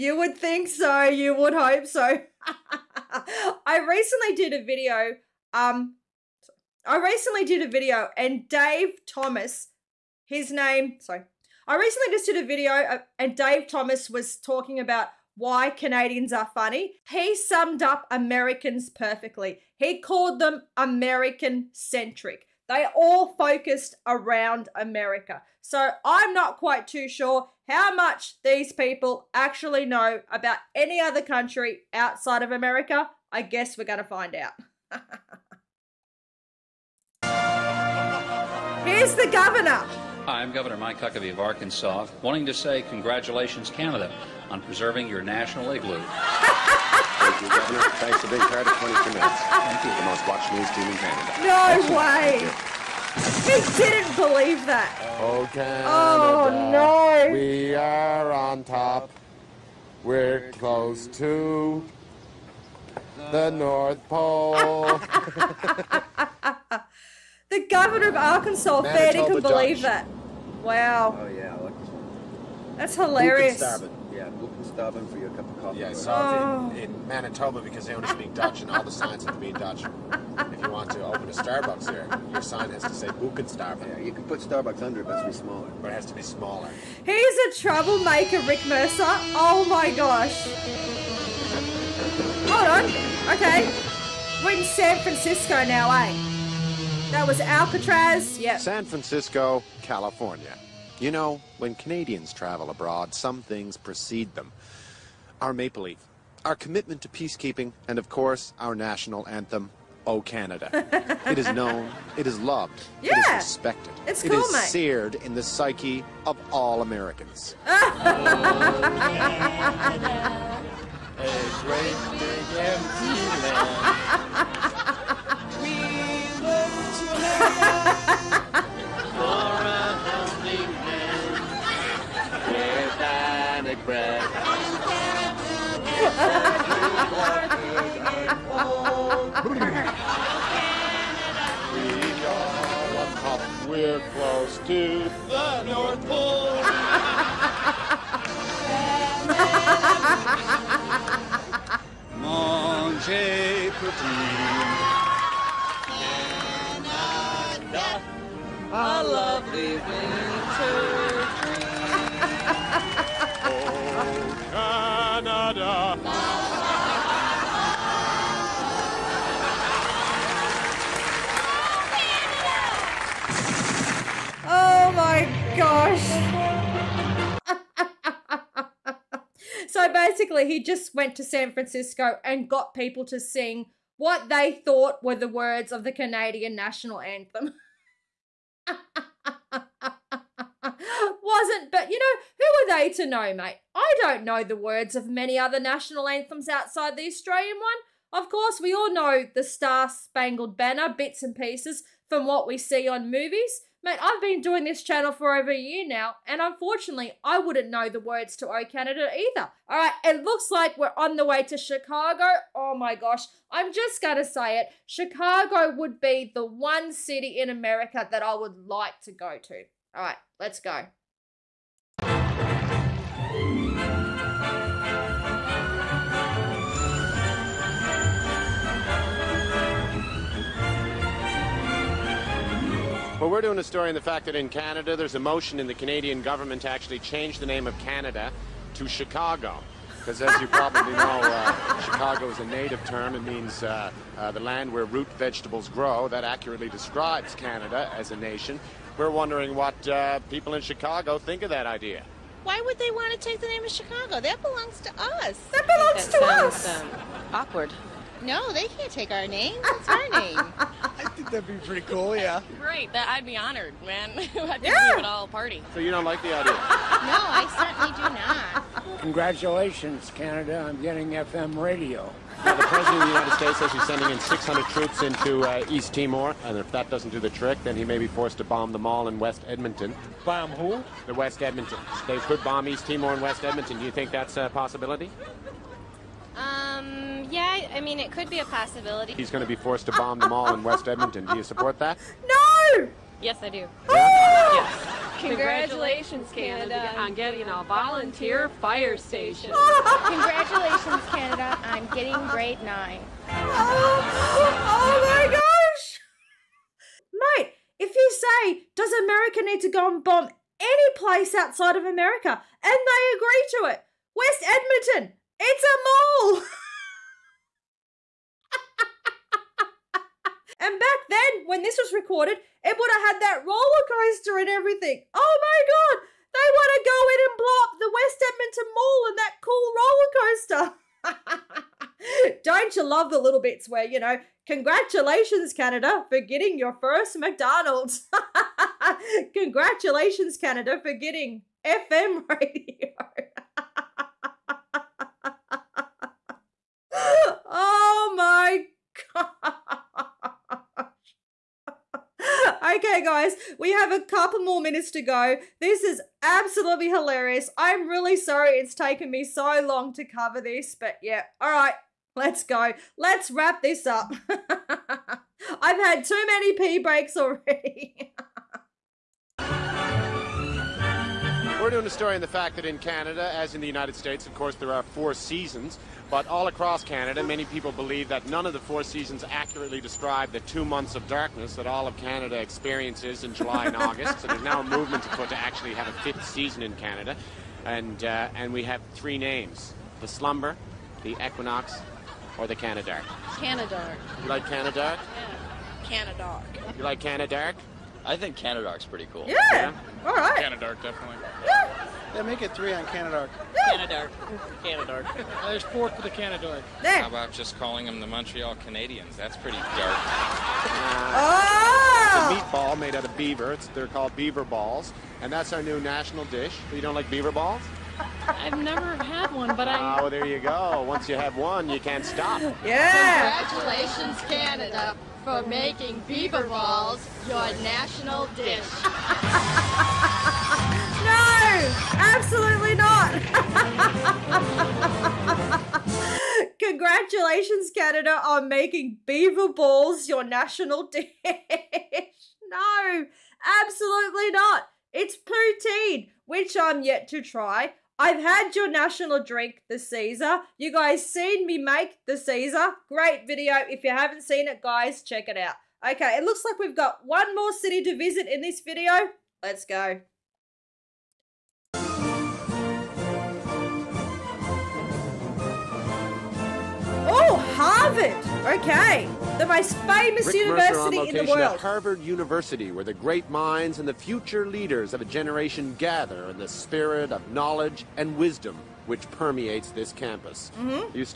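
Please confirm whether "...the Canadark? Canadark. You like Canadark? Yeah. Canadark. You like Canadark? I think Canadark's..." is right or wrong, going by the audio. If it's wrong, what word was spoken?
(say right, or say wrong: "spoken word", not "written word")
right.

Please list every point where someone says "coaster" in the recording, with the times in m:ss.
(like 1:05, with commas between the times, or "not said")
5:23, 5:32.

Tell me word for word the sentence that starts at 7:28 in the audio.
I've had your national drink, the Caesar.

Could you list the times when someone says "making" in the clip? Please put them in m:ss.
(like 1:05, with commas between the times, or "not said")
7:05, 7:18.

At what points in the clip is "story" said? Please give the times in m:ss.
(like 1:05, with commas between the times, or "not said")
3:53, 6:11.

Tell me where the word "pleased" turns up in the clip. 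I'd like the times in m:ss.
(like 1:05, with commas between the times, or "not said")
not said.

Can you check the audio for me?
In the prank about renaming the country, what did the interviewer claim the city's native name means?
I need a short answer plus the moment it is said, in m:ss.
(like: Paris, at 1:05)
the land where root vegetables grow, at 4:04.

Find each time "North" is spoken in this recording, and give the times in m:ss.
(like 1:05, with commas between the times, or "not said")
1:03, 2:25.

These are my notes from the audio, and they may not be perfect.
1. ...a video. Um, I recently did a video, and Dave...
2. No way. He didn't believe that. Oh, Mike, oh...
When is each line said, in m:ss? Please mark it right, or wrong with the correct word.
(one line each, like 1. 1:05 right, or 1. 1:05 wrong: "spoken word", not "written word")
1. 0:04 right
2. 0:51 wrong: "Canada", not "Mike".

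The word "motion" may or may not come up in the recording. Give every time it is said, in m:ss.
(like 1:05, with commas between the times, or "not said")
3:55.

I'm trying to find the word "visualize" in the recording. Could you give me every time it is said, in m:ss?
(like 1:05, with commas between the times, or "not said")
not said.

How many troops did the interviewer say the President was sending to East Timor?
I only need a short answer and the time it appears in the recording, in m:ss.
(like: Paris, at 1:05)
600, at 4:34.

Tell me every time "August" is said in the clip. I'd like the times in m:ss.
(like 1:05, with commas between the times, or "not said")
6:23.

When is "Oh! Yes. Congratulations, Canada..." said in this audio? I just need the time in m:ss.
4:53.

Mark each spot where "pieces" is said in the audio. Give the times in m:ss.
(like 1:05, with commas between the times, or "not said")
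3:21.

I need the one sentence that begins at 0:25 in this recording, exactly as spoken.
So I'm not quite too sure how much these people actually know about any other country outside of America.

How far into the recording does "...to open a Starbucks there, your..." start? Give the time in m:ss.
1:20.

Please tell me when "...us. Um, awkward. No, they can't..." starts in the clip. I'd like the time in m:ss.
4:16.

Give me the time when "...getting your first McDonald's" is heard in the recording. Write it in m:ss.
5:36.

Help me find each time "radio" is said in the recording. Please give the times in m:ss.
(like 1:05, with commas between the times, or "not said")
4:31, 5:42.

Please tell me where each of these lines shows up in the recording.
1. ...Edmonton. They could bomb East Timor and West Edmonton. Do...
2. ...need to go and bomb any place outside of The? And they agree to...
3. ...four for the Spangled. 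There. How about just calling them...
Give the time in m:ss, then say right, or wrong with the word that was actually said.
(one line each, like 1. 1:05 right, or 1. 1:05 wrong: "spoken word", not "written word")
1. 4:41 right
2. 5:09 wrong: "America", not "The"
3. 6:45 wrong: "Canadark", not "Spangled".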